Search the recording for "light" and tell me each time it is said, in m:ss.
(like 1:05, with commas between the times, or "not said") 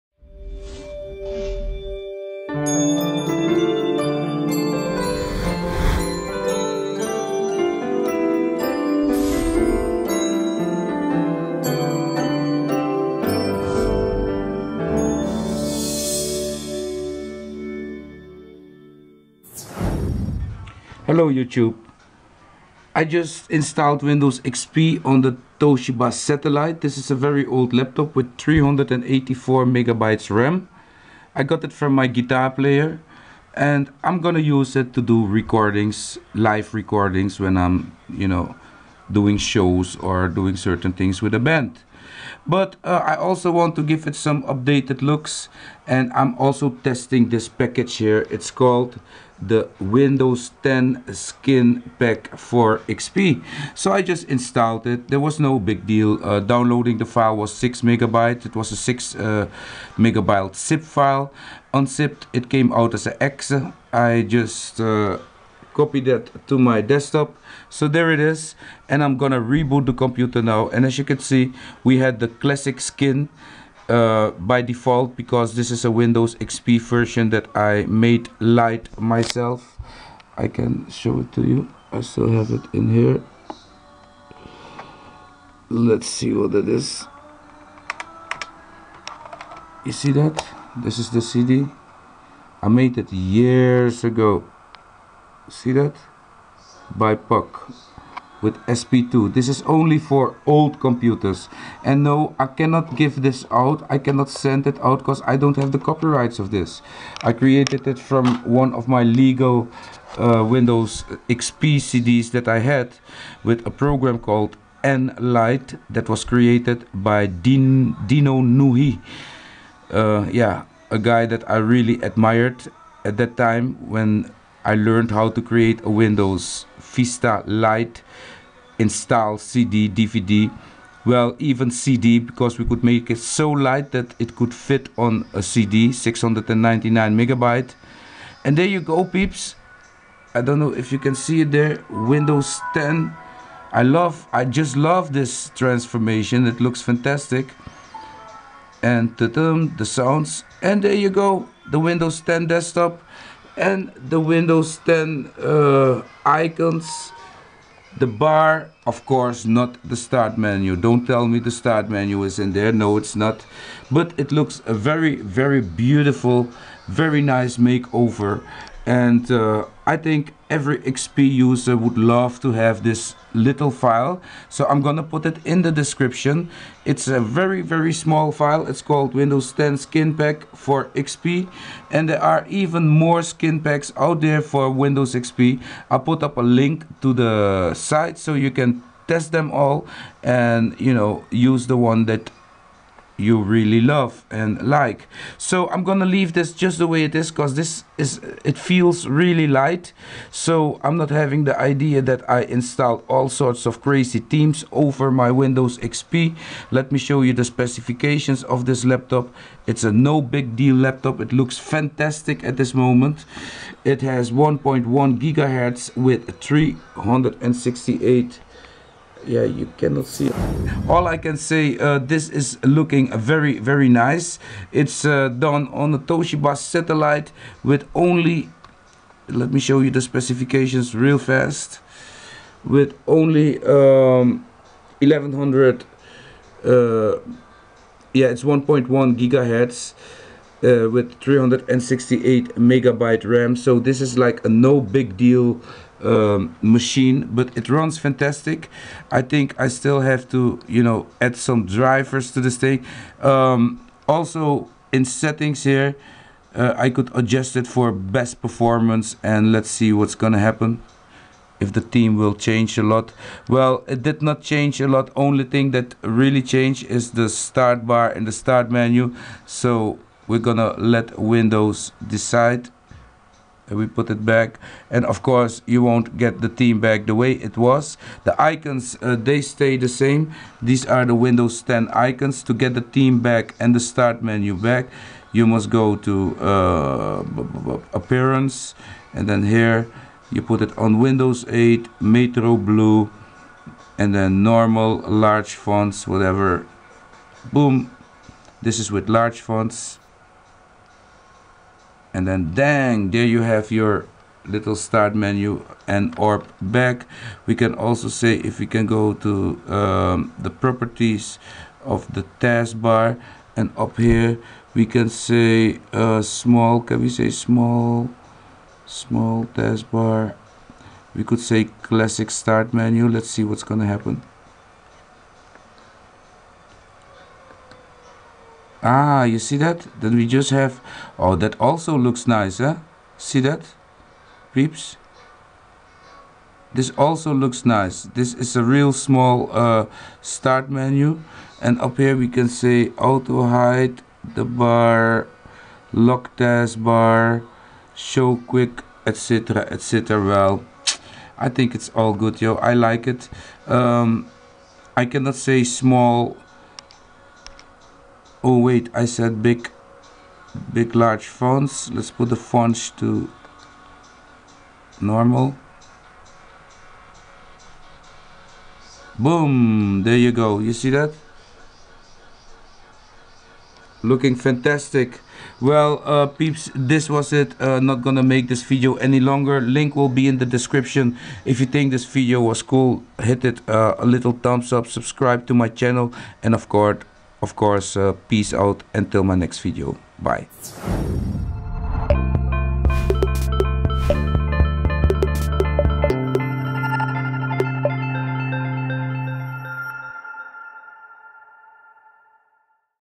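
1:18, 2:13, 3:19.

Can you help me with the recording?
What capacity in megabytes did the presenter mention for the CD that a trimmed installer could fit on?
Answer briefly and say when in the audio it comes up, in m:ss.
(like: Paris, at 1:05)
699, at 2:15.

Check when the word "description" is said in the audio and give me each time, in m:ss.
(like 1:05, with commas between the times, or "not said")
2:55, 6:20.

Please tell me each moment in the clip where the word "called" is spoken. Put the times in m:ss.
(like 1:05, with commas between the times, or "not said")
0:48, 1:54, 2:58.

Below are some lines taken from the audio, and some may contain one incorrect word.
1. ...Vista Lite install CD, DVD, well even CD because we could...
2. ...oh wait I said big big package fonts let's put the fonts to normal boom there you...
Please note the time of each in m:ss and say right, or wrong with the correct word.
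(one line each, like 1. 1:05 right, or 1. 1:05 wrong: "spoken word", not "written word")
1. 2:06 right
2. 5:58 wrong: "large", not "package".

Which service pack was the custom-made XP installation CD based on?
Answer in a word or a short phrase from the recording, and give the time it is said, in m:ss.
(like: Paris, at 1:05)
SP2, at 1:38.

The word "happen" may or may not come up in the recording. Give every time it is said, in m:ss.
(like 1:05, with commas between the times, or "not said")
4:20, 5:23.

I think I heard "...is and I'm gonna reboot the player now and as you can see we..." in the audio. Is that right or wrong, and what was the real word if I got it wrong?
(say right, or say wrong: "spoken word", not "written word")
wrong: "computer", not "player".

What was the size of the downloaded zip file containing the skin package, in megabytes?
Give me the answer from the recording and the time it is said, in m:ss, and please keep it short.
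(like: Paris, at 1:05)
6, at 0:57.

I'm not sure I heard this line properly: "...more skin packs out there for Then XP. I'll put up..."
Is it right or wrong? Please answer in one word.
wrong.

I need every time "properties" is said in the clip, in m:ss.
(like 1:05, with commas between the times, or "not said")
5:10.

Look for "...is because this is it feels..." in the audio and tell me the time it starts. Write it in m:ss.
3:17.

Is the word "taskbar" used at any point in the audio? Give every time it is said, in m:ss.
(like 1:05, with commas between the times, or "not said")
5:12, 5:19, 5:46.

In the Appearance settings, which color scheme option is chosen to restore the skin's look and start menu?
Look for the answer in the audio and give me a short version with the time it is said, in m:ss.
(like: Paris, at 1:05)
Windows 8 Metro Blue, at 4:50.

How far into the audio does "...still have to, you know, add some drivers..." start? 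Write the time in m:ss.
4:09.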